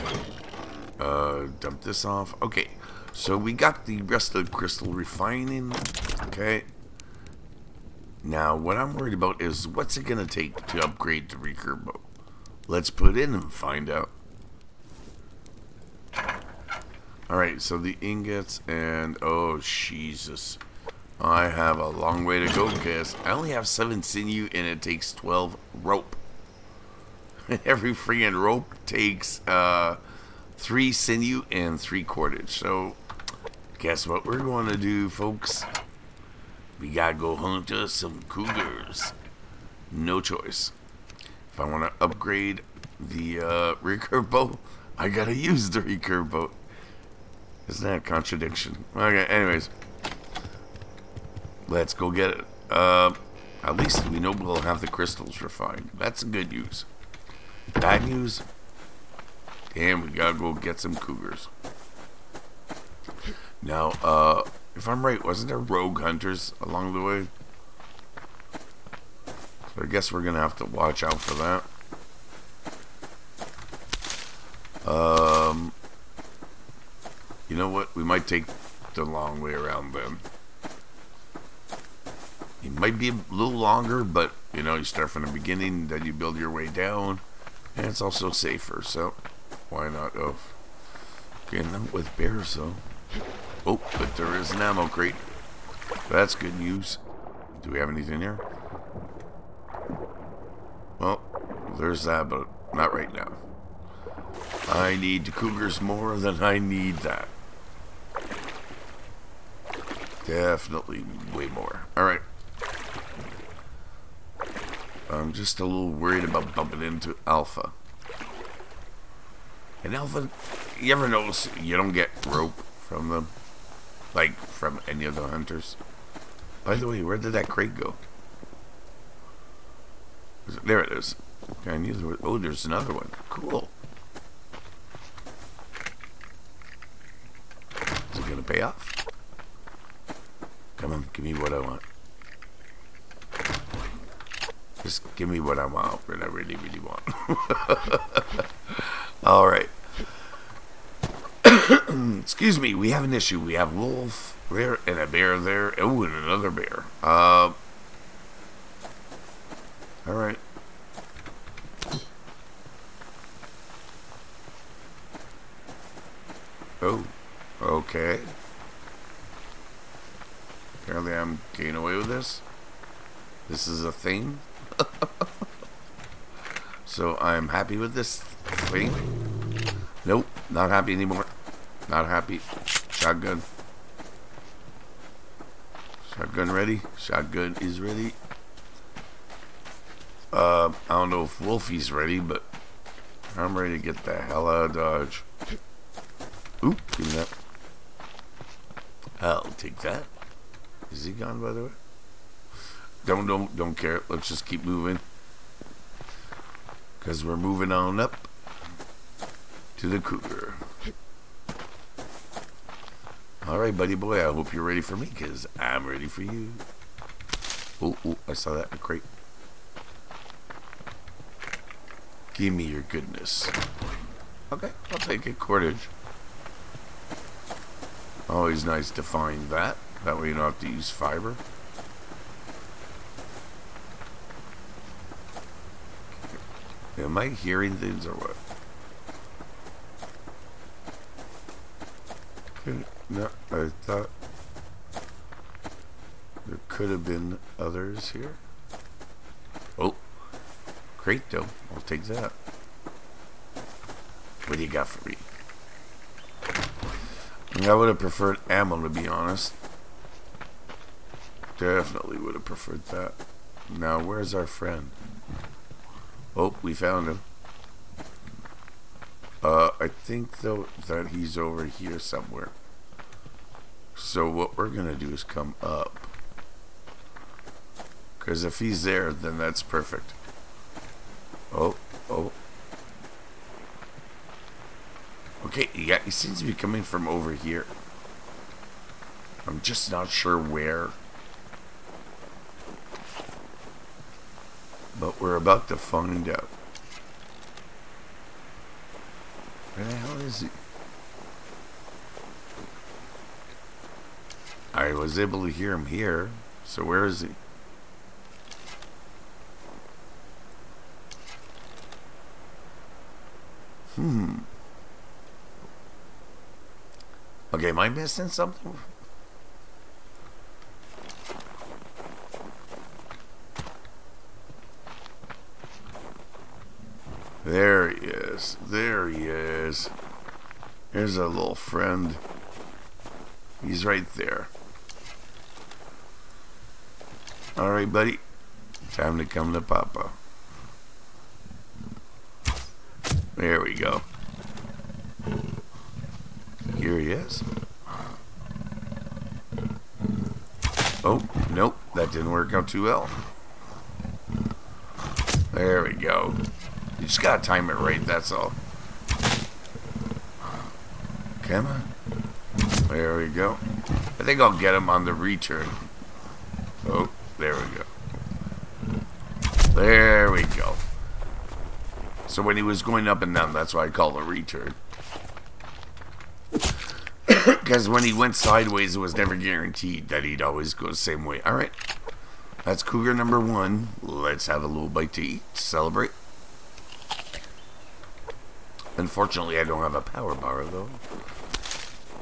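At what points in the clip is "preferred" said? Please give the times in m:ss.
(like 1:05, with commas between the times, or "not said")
4:17, 4:22.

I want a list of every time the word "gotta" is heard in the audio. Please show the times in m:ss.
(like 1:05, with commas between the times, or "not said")
0:36, 0:45, 1:00, 5:57.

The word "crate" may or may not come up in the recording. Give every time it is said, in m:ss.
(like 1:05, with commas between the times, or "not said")
1:34, 2:07, 3:38.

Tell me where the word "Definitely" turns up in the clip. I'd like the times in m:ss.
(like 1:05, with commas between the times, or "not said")
1:50, 4:21.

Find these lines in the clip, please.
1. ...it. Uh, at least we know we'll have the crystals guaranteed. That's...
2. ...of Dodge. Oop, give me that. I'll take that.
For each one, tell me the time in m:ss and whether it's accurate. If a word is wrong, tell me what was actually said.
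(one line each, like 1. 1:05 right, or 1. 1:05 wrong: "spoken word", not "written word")
1. 0:52 wrong: "refined", not "guaranteed"
2. 3:14 right.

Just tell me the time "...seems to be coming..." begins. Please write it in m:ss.
4:46.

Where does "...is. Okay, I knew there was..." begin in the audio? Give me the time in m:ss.
2:10.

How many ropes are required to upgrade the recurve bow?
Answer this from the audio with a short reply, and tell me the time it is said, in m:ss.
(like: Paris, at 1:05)
12, at 0:25.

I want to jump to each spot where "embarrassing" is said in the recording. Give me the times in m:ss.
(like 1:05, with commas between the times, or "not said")
not said.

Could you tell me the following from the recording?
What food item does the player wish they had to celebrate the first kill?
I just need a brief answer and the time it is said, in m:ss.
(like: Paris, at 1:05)
Power bar, at 6:29.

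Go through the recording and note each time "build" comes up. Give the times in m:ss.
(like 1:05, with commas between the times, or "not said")
1:26.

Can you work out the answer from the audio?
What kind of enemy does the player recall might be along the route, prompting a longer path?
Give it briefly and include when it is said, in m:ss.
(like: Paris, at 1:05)
Rogue hunters, at 1:05.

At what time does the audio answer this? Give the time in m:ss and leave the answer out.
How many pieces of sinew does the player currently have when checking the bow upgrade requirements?
0:23.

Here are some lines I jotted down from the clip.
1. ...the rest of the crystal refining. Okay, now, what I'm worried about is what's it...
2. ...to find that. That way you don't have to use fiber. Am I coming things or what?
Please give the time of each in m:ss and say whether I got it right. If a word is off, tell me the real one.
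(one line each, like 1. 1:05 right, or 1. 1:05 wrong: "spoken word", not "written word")
1. 0:03 right
2. 3:48 wrong: "hearing", not "coming".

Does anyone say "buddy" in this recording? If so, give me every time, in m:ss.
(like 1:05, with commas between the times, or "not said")
3:33, 5:37.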